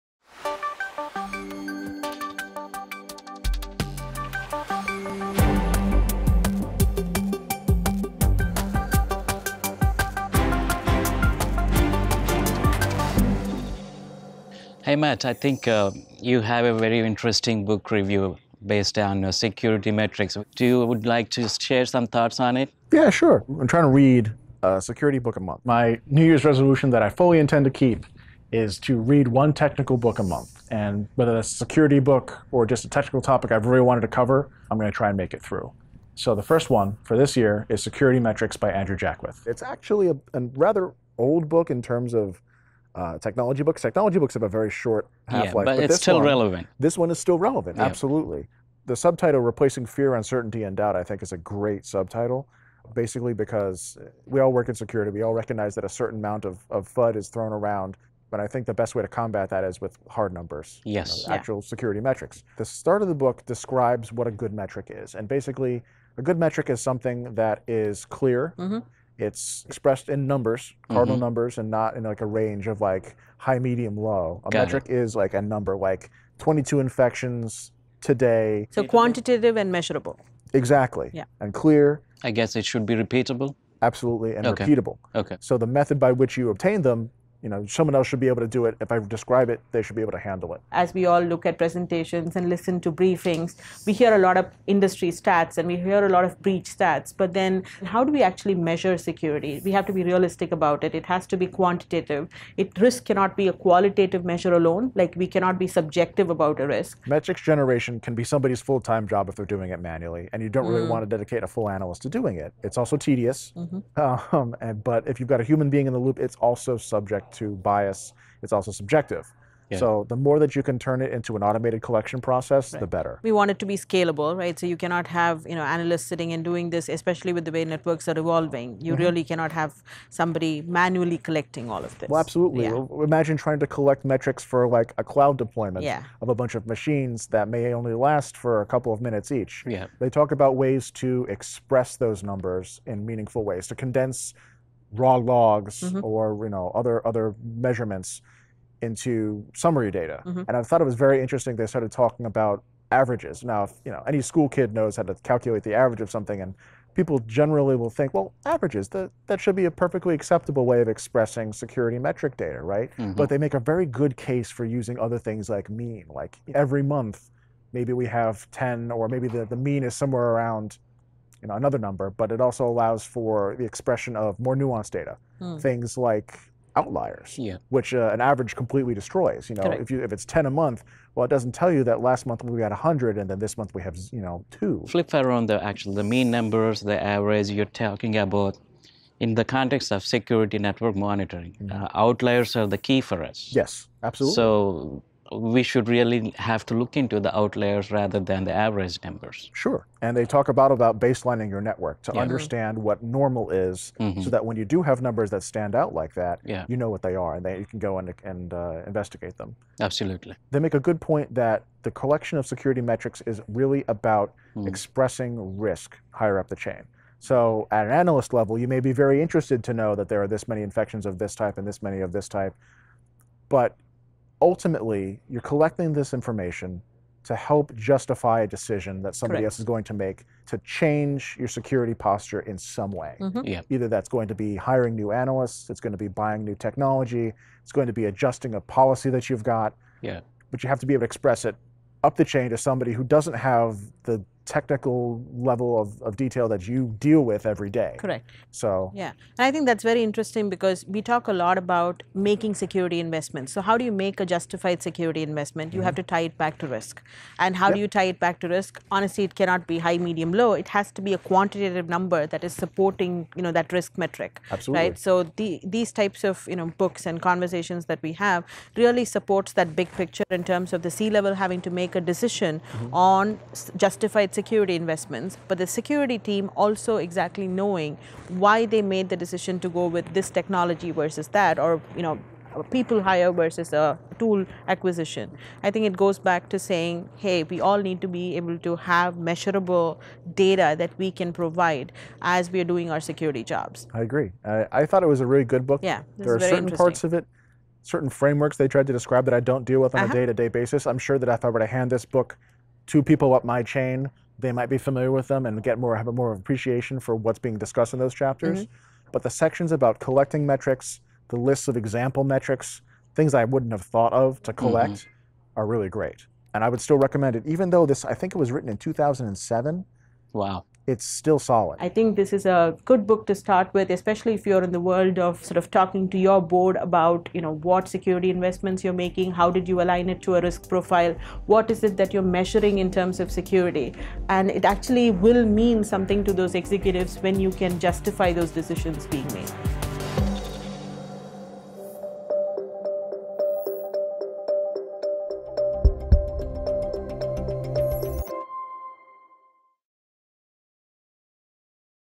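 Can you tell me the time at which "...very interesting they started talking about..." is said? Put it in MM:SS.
02:30.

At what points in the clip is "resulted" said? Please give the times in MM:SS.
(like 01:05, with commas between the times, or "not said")
not said.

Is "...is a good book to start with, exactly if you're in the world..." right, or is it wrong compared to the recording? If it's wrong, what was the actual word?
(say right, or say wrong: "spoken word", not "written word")
wrong: "especially", not "exactly".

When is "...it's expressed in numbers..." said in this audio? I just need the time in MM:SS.
01:09.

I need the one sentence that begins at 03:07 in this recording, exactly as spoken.
You're talking about in the context of security network monitoring.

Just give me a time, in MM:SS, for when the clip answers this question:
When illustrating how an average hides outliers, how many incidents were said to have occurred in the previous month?
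03:02.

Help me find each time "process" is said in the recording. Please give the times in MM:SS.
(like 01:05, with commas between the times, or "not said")
02:02.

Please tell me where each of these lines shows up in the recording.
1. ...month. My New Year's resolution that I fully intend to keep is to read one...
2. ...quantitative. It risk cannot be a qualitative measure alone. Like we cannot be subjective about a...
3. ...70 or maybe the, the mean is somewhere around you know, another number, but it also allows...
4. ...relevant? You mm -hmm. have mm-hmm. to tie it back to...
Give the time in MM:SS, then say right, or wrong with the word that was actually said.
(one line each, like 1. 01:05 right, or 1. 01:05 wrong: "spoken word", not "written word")
1. 00:25 right
2. 01:41 right
3. 02:48 wrong: "10", not "70"
4. 04:15 wrong: "investment", not "relevant".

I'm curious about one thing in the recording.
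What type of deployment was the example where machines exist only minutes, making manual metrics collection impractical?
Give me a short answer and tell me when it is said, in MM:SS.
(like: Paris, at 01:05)
cloud deployment, at 02:15.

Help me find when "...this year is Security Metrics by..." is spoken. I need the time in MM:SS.
00:37.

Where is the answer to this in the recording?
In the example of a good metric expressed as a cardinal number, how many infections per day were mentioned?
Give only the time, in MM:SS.
01:16.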